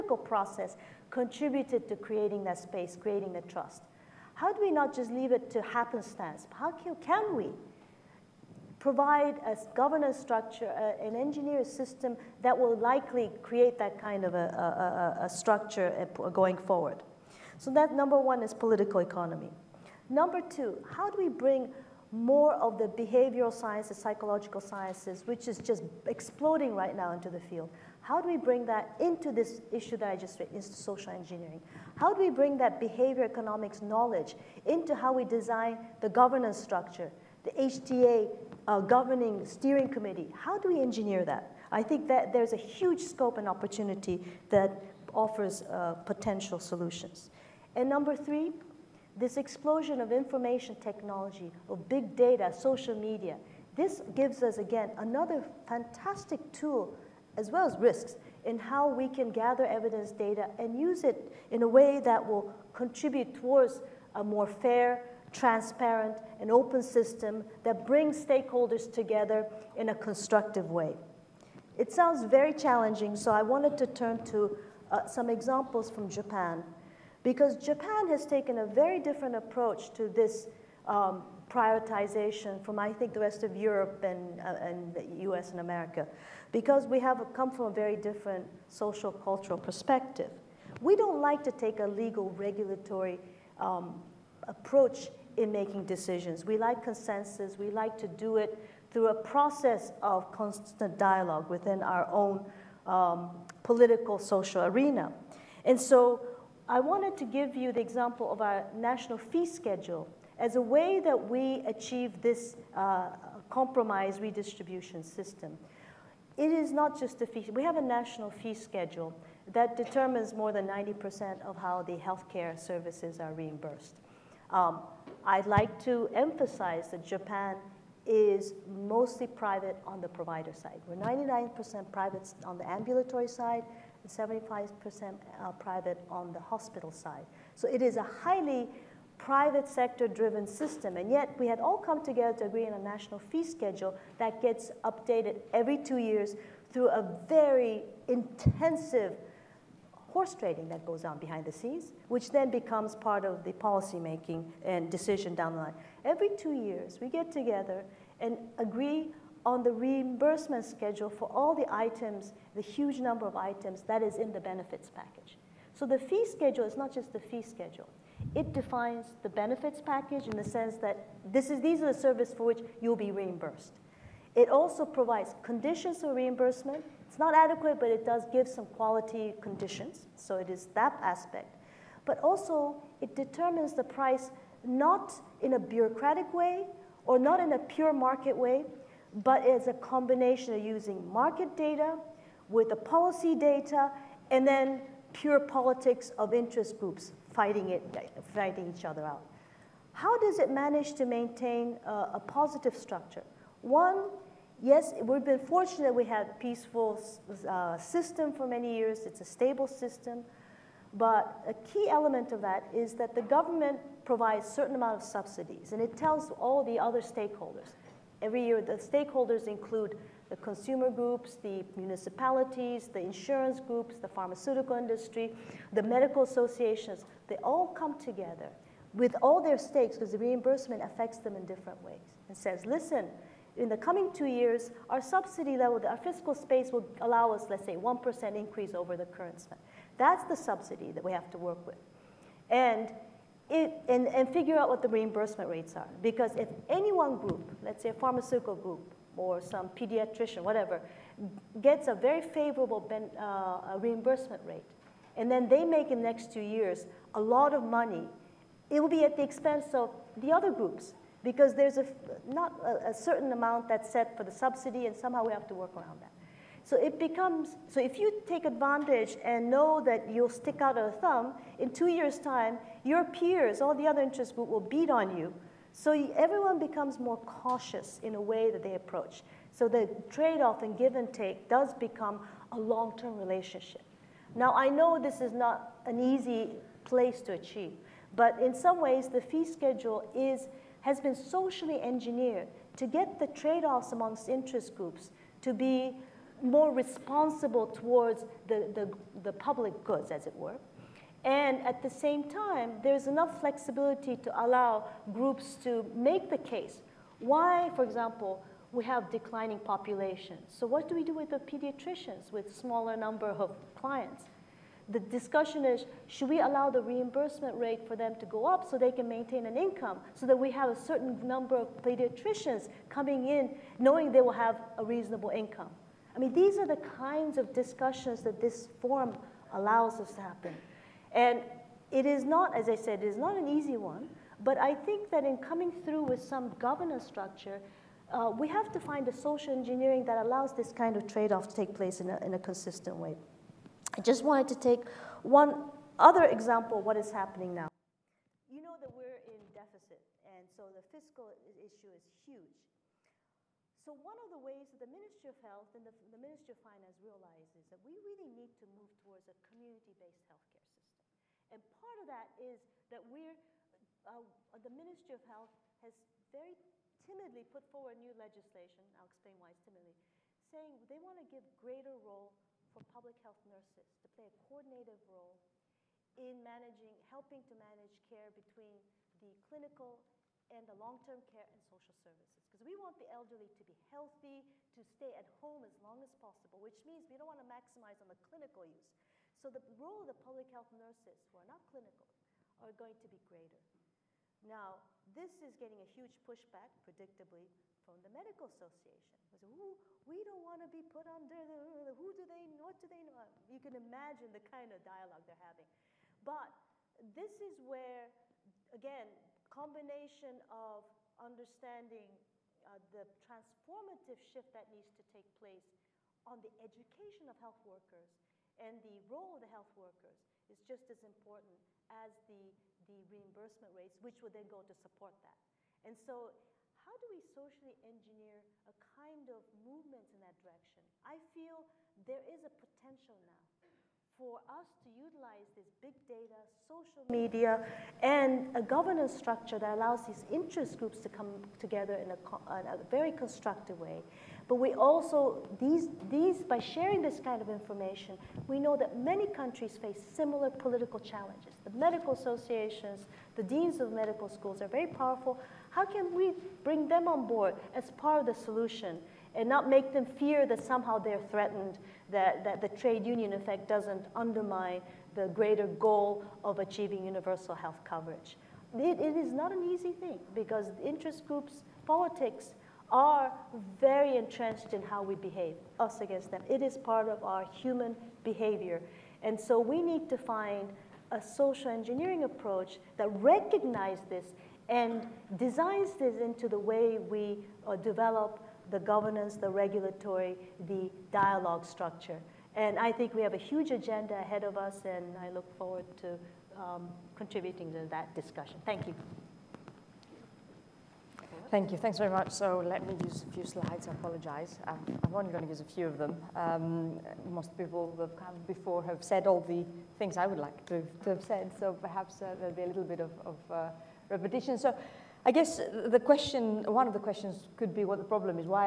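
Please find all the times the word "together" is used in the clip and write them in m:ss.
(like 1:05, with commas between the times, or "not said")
1:08, 2:22, 2:37, 3:47, 7:21.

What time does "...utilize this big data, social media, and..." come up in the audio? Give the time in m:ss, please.
7:14.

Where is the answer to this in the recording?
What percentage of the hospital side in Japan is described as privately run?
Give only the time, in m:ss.
2:14.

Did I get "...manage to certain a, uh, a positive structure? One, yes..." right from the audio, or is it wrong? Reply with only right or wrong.
wrong.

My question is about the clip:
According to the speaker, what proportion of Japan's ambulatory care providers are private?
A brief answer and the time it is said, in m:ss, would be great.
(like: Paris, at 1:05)
99%, at 2:10.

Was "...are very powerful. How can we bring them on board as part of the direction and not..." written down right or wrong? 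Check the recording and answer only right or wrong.
wrong.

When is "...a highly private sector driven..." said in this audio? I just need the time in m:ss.
2:17.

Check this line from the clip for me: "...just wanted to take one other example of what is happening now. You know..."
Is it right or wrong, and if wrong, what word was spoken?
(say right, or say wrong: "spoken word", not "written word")
right.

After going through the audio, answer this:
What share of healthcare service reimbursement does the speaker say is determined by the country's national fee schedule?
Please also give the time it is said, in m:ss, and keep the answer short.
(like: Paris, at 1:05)
more than 90%, at 2:00.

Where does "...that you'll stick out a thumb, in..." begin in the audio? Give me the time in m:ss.
4:29.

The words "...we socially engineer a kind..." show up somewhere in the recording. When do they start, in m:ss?
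7:07.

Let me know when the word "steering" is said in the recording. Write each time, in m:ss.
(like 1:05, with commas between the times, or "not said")
0:39.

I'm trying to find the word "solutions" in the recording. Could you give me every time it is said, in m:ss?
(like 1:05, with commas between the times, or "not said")
0:46, 7:38.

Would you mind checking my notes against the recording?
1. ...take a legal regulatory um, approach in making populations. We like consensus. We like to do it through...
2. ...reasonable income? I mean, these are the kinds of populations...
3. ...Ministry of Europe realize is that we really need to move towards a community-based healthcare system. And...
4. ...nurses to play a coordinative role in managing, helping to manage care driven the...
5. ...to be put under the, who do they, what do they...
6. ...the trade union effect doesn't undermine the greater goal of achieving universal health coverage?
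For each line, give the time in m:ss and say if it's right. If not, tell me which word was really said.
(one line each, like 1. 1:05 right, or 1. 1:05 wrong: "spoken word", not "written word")
1. 1:31 wrong: "decisions", not "populations"
2. 5:24 wrong: "discussions", not "populations"
3. 5:56 wrong: "Finance", not "Europe"
4. 6:13 wrong: "between", not "driven"
5. 6:40 right
6. 7:42 right.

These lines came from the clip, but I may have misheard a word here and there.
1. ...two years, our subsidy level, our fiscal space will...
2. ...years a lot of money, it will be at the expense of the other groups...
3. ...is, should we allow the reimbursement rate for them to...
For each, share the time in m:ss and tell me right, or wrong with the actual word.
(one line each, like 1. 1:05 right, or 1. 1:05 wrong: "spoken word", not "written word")
1. 3:54 right
2. 4:16 right
3. 5:15 right.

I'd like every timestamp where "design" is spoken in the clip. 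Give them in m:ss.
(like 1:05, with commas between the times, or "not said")
0:35, 8:05.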